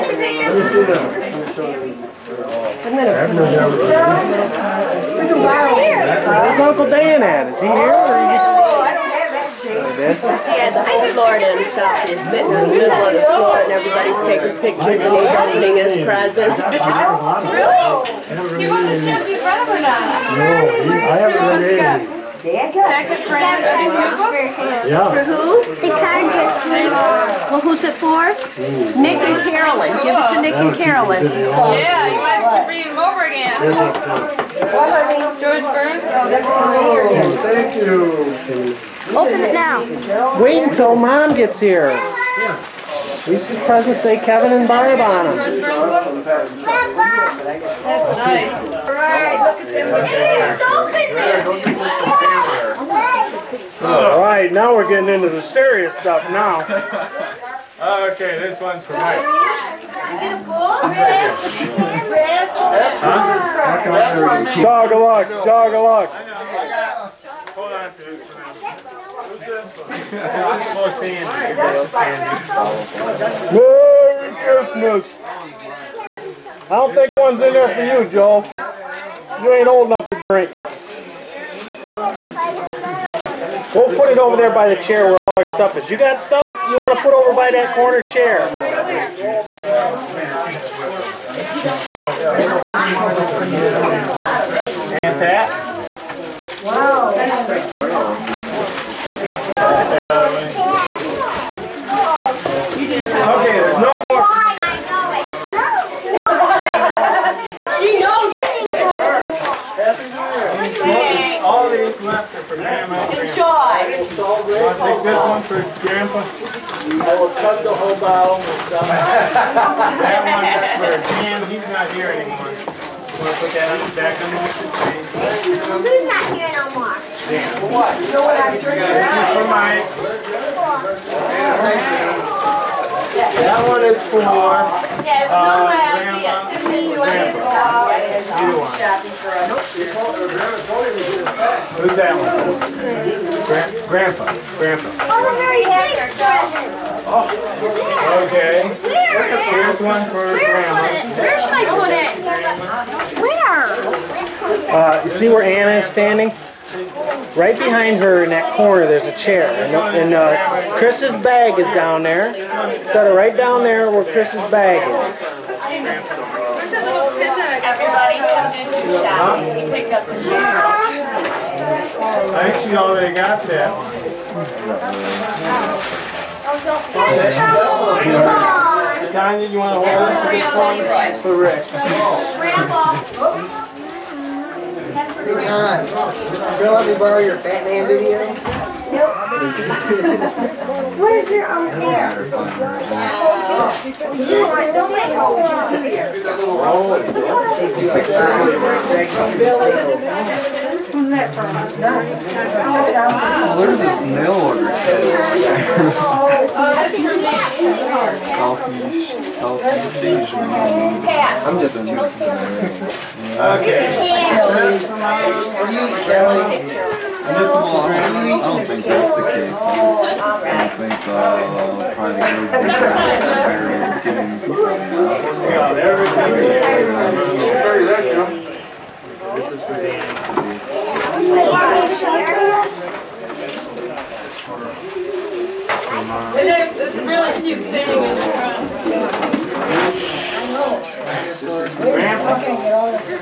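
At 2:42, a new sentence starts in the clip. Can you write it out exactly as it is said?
Set it right down there where Chris's bag is.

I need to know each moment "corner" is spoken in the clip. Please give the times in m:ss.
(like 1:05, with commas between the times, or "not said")
1:27, 2:38.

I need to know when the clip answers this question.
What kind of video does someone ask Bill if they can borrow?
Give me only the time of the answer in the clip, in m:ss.
3:07.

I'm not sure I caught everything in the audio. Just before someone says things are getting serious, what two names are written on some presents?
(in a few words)
Kevin and Barb.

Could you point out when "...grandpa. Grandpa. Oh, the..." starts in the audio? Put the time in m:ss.
2:23.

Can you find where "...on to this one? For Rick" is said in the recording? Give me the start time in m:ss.
3:00.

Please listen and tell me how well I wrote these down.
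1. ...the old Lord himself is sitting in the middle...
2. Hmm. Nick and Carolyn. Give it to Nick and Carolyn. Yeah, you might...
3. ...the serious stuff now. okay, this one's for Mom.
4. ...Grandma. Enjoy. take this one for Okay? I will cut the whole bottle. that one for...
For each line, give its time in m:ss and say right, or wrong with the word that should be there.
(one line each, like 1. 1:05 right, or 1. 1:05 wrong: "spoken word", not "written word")
1. 0:10 right
2. 0:28 right
3. 0:55 wrong: "Mike", not "Mom"
4. 1:52 wrong: "Grandpa", not "Okay".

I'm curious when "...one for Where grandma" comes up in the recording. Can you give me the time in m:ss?
2:29.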